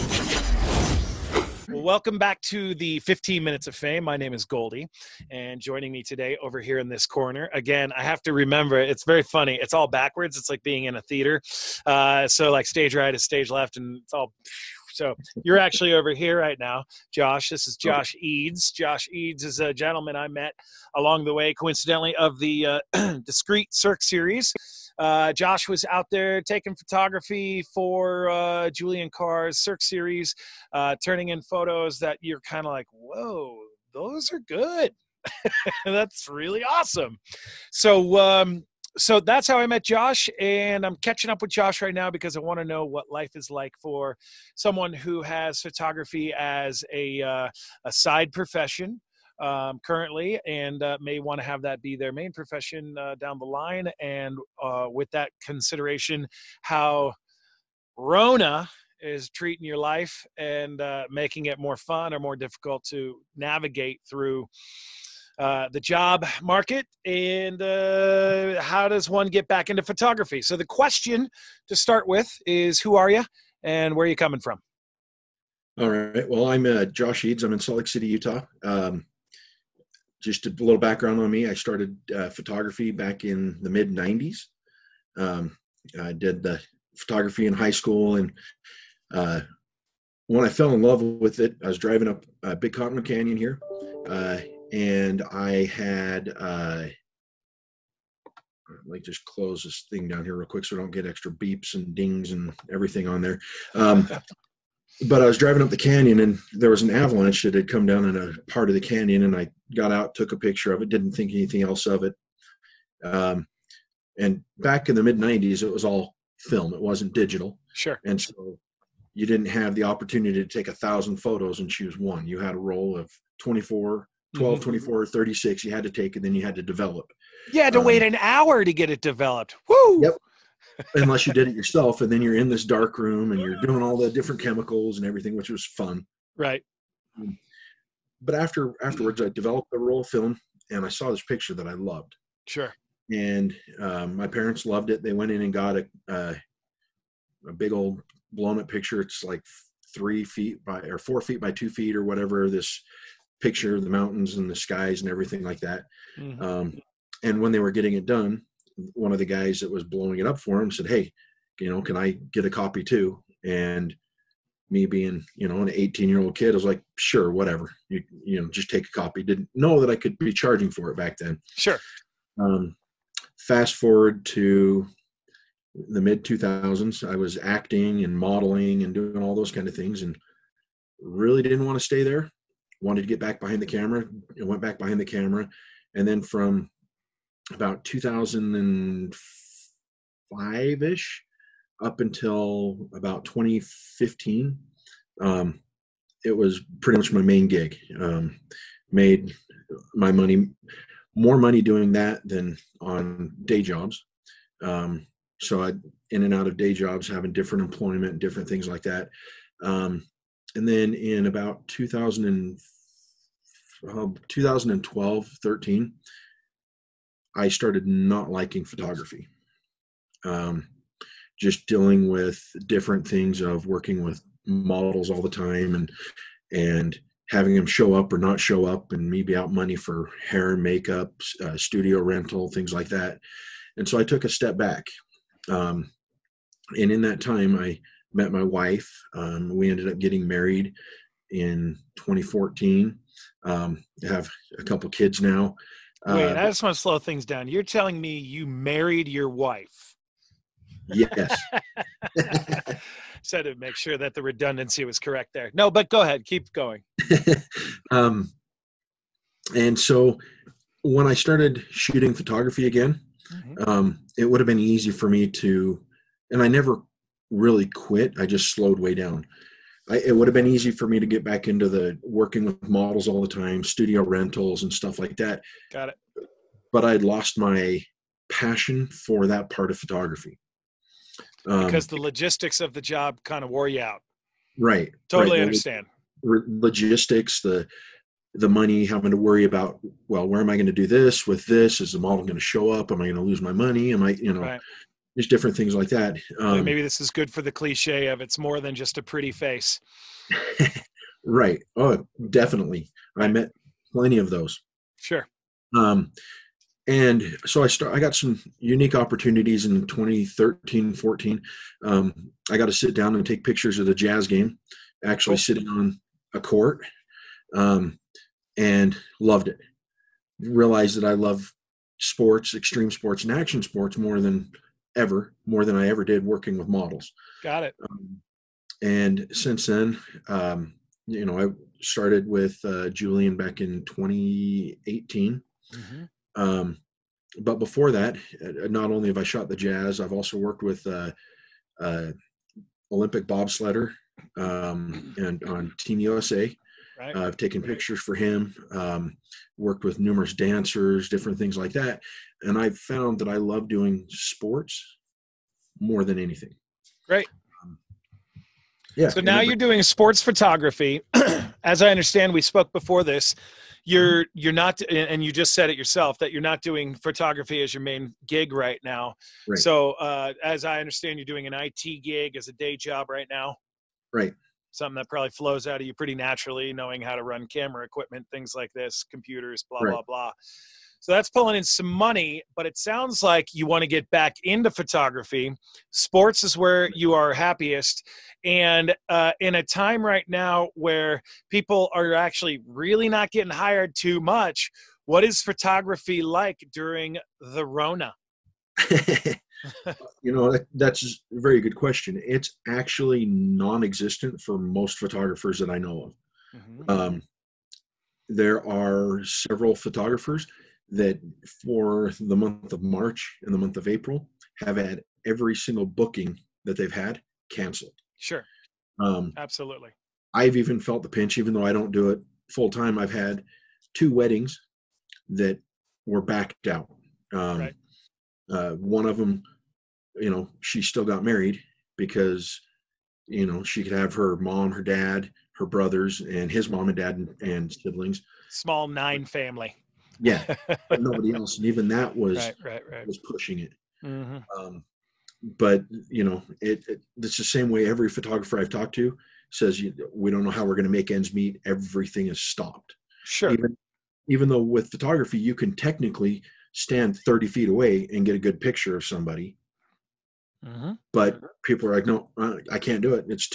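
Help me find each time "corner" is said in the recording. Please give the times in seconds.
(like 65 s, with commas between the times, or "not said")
7 s.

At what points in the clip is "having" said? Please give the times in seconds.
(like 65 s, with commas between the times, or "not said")
207 s, 227 s, 288 s.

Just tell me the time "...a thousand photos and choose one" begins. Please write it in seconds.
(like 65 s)
120 s.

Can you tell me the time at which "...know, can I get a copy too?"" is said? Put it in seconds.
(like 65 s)
161 s.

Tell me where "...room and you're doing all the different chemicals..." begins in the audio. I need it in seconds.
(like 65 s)
132 s.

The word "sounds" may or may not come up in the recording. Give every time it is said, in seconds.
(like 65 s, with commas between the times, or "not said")
382 s.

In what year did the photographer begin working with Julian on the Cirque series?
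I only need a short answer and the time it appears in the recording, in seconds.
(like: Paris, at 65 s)
2018, at 333 s.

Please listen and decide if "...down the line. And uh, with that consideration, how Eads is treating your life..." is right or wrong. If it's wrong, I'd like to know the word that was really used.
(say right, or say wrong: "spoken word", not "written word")
wrong: "Rona", not "Eads".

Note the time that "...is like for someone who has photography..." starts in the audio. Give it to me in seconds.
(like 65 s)
43 s.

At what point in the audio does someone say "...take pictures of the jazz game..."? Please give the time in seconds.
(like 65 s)
313 s.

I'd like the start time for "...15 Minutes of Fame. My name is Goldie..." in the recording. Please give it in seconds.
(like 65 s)
2 s.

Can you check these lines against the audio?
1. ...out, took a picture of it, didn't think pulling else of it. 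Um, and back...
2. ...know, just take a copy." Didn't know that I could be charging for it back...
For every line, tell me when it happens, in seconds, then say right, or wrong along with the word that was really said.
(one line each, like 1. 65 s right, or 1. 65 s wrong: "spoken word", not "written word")
1. 109 s wrong: "anything", not "pulling"
2. 168 s right.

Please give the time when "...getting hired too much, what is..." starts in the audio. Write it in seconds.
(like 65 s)
393 s.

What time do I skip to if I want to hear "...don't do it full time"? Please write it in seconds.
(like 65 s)
421 s.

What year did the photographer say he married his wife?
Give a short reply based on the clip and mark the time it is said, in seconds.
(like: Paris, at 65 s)
2014, at 241 s.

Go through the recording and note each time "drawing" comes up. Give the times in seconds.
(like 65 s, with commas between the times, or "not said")
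not said.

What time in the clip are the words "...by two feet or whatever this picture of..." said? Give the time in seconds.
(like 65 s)
151 s.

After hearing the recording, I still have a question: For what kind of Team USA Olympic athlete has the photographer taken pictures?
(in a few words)
Bobsledder.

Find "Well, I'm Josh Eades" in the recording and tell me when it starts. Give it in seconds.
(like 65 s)
76 s.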